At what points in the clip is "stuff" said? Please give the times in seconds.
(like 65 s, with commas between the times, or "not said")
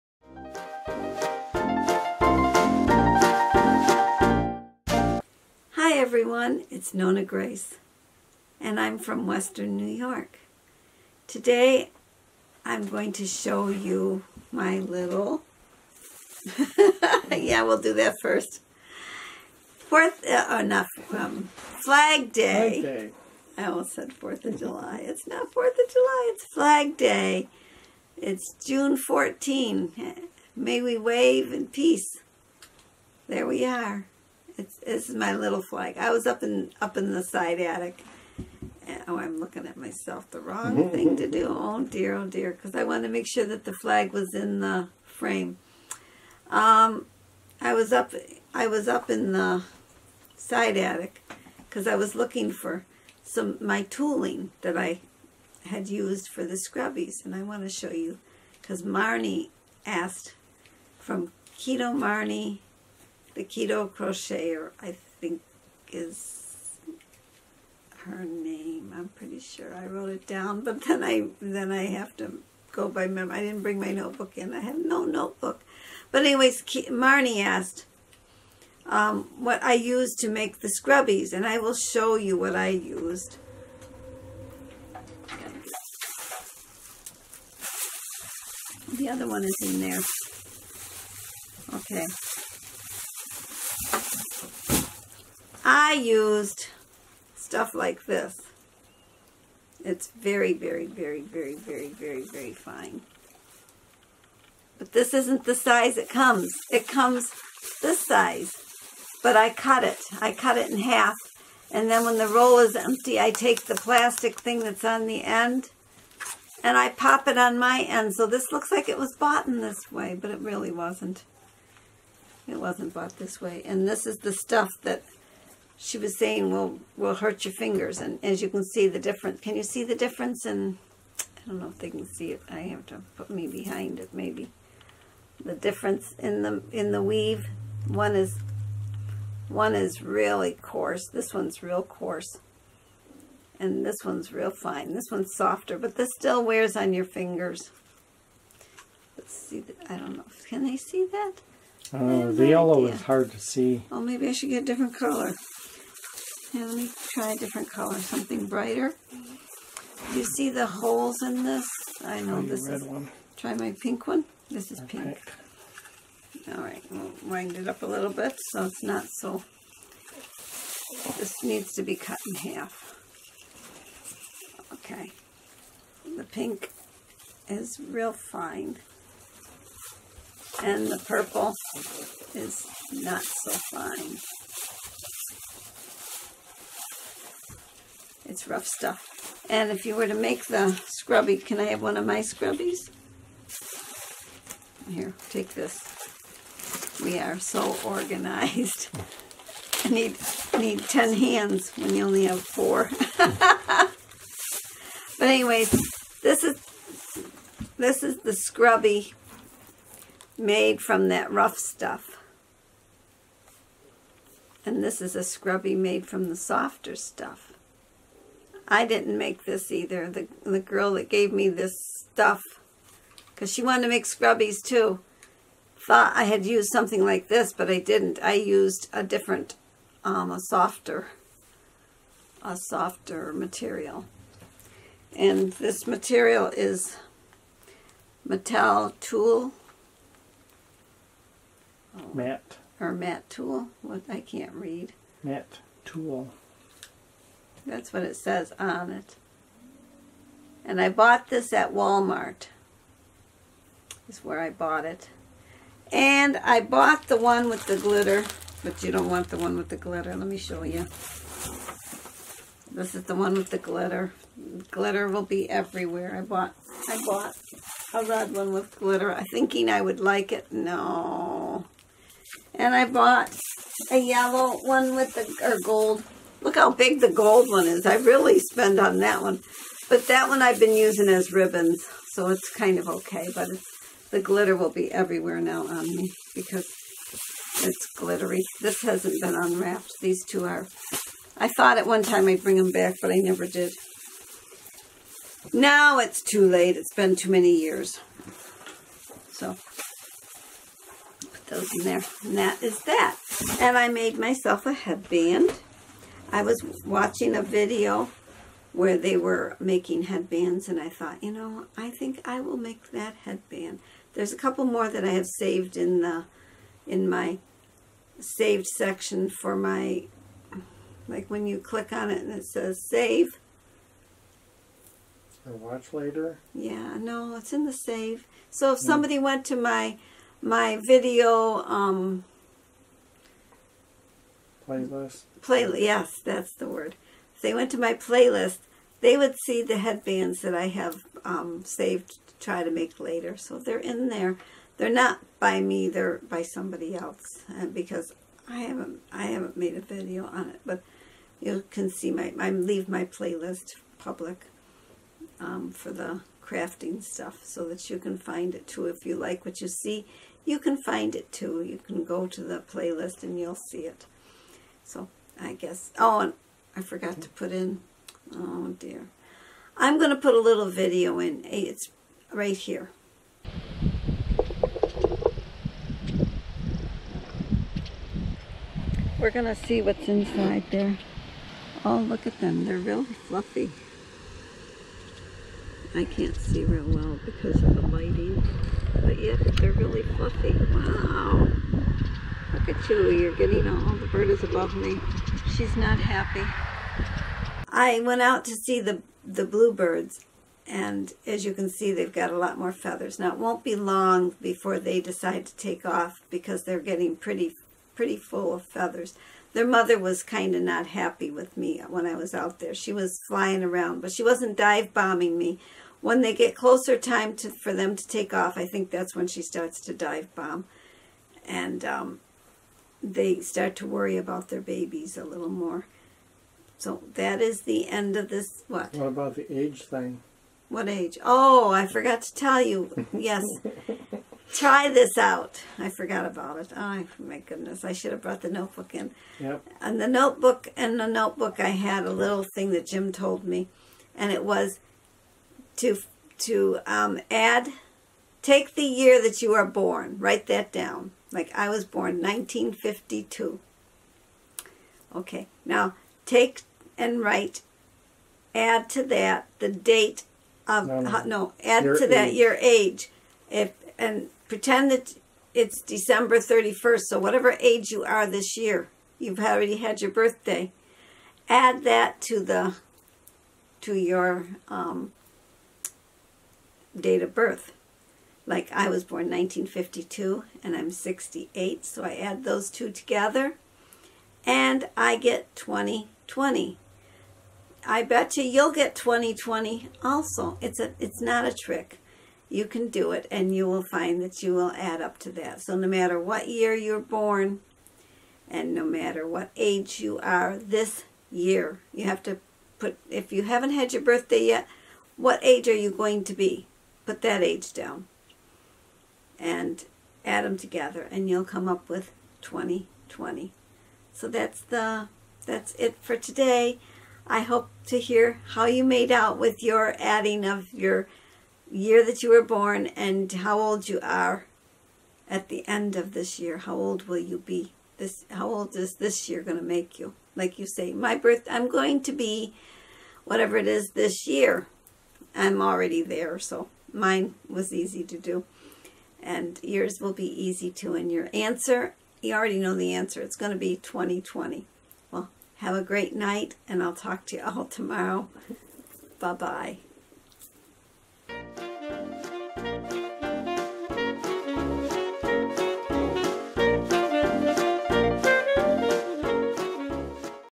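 97 s, 124 s, 188 s, 211 s, 216 s, 221 s, 357 s.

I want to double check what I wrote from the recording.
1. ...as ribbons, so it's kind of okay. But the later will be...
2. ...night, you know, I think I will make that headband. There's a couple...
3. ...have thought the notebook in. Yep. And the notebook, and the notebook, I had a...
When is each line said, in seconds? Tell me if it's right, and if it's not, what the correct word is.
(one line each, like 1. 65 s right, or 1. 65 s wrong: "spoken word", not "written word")
1. 281 s wrong: "glitter", not "later"
2. 310 s wrong: "thought", not "night"
3. 438 s wrong: "brought", not "thought".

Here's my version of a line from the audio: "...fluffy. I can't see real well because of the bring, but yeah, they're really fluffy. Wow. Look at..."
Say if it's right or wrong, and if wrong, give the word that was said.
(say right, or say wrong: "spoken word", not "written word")
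wrong: "lighting", not "bring".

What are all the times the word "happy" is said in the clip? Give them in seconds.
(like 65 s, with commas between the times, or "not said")
395 s, 410 s.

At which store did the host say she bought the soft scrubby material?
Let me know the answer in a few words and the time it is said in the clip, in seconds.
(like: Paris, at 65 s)
Walmart, at 251 s.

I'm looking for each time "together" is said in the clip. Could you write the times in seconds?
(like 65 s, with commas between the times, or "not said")
482 s, 510 s.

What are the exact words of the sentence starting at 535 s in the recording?
I'm already there, so mine was easy to do and yours will be easy too.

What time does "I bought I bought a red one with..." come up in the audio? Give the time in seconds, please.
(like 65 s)
266 s.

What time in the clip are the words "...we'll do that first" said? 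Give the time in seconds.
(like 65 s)
17 s.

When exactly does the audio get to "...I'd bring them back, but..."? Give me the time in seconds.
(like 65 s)
292 s.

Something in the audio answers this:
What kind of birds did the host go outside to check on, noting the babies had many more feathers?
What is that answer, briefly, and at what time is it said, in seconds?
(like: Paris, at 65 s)
bluebirds, at 399 s.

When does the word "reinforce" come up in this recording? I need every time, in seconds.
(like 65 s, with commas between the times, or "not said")
not said.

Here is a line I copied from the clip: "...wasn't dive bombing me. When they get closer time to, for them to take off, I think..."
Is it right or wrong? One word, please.
right.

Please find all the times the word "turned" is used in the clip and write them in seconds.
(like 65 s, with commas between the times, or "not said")
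not said.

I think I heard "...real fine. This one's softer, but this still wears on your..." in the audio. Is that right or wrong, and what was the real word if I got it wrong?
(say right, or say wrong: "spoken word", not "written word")
right.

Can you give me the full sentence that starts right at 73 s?
I didn't bring my notebook in.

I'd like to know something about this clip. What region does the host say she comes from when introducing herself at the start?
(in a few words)
Western New York.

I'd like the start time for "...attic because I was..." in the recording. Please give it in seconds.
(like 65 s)
50 s.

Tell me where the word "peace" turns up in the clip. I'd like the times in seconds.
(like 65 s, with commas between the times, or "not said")
31 s.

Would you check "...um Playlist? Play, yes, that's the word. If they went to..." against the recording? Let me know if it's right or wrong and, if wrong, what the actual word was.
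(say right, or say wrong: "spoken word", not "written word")
right.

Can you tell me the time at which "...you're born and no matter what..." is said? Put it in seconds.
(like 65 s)
496 s.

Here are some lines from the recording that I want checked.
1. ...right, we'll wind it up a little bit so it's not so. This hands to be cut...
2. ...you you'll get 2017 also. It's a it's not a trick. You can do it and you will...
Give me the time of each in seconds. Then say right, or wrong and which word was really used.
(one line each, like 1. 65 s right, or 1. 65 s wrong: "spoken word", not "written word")
1. 166 s wrong: "needs", not "hands"
2. 488 s wrong: "2020", not "2017".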